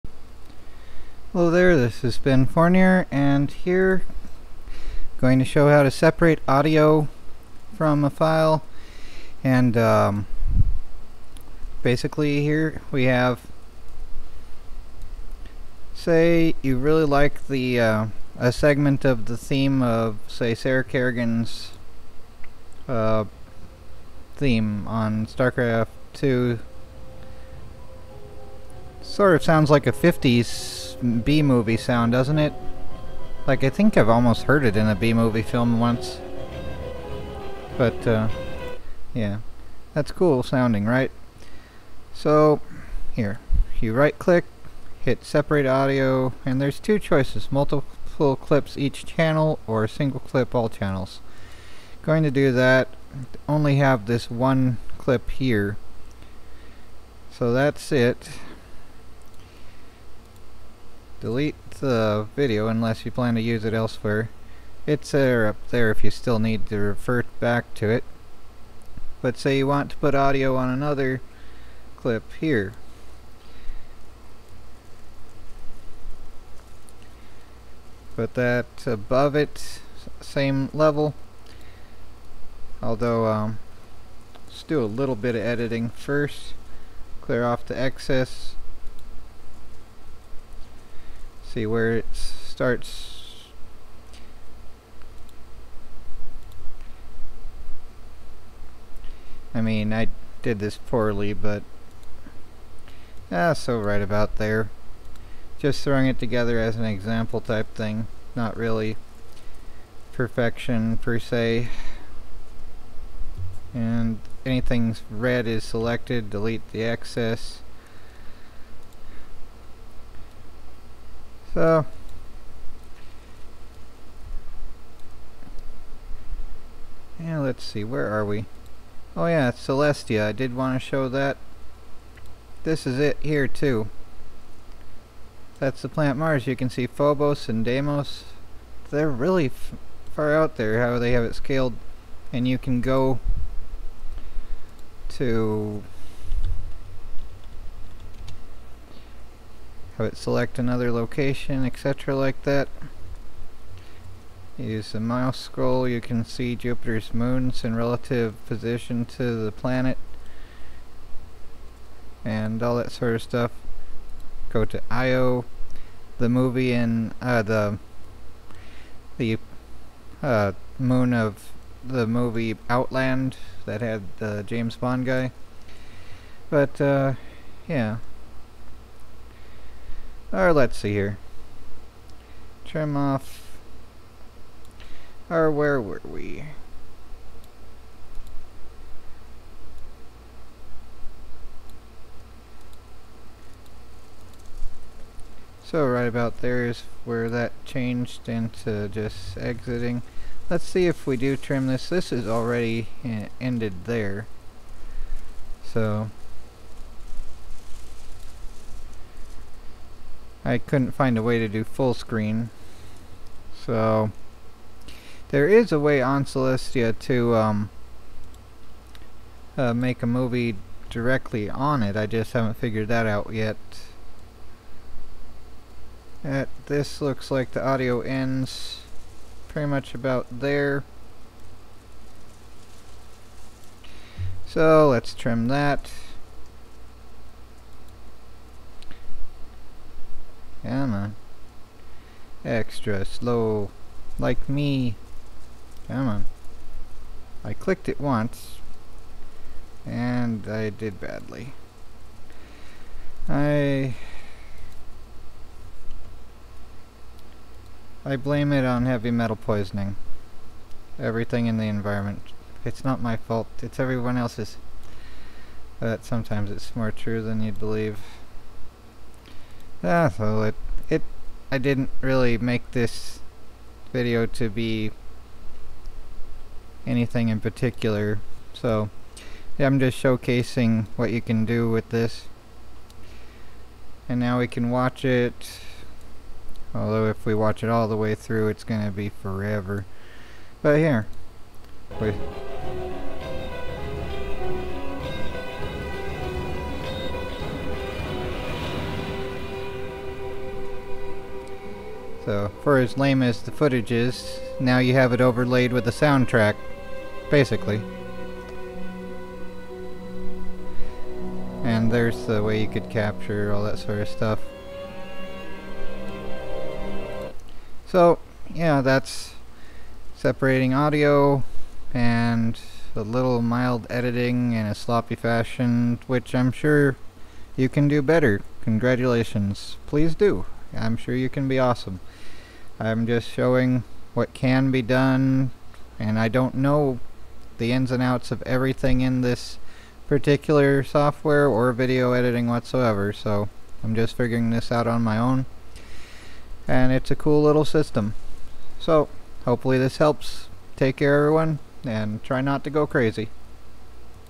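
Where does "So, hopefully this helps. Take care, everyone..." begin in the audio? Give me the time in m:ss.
5:48.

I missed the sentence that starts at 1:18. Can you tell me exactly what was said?
Put that above it, same level.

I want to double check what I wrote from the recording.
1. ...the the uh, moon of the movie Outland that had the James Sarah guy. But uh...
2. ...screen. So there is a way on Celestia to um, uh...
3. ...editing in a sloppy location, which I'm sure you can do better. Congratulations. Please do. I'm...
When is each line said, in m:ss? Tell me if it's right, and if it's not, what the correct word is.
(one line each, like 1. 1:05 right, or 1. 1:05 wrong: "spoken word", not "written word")
1. 2:47 wrong: "Bond", not "Sarah"
2. 3:31 right
3. 5:23 wrong: "fashion", not "location".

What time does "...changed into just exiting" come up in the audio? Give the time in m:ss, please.
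3:17.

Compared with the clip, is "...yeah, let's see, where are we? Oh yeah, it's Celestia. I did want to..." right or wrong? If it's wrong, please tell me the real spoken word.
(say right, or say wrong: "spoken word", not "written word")
right.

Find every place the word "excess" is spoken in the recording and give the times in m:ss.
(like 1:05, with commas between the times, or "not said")
1:27, 1:56.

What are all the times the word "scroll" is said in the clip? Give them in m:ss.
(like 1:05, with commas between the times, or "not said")
2:35.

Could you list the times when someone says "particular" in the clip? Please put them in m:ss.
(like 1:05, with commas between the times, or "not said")
4:37, 5:40.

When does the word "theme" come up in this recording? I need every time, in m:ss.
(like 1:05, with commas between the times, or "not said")
0:19, 0:24.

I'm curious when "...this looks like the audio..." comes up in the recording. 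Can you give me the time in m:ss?
3:46.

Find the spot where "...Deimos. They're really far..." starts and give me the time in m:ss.
2:17.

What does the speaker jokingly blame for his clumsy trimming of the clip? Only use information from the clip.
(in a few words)
Heavy metal poisoning.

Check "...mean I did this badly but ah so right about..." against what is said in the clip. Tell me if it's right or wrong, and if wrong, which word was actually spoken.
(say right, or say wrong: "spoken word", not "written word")
wrong: "poorly", not "badly".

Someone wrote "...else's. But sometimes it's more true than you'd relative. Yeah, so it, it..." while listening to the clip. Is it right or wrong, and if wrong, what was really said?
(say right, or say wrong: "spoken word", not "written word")
wrong: "believe", not "relative".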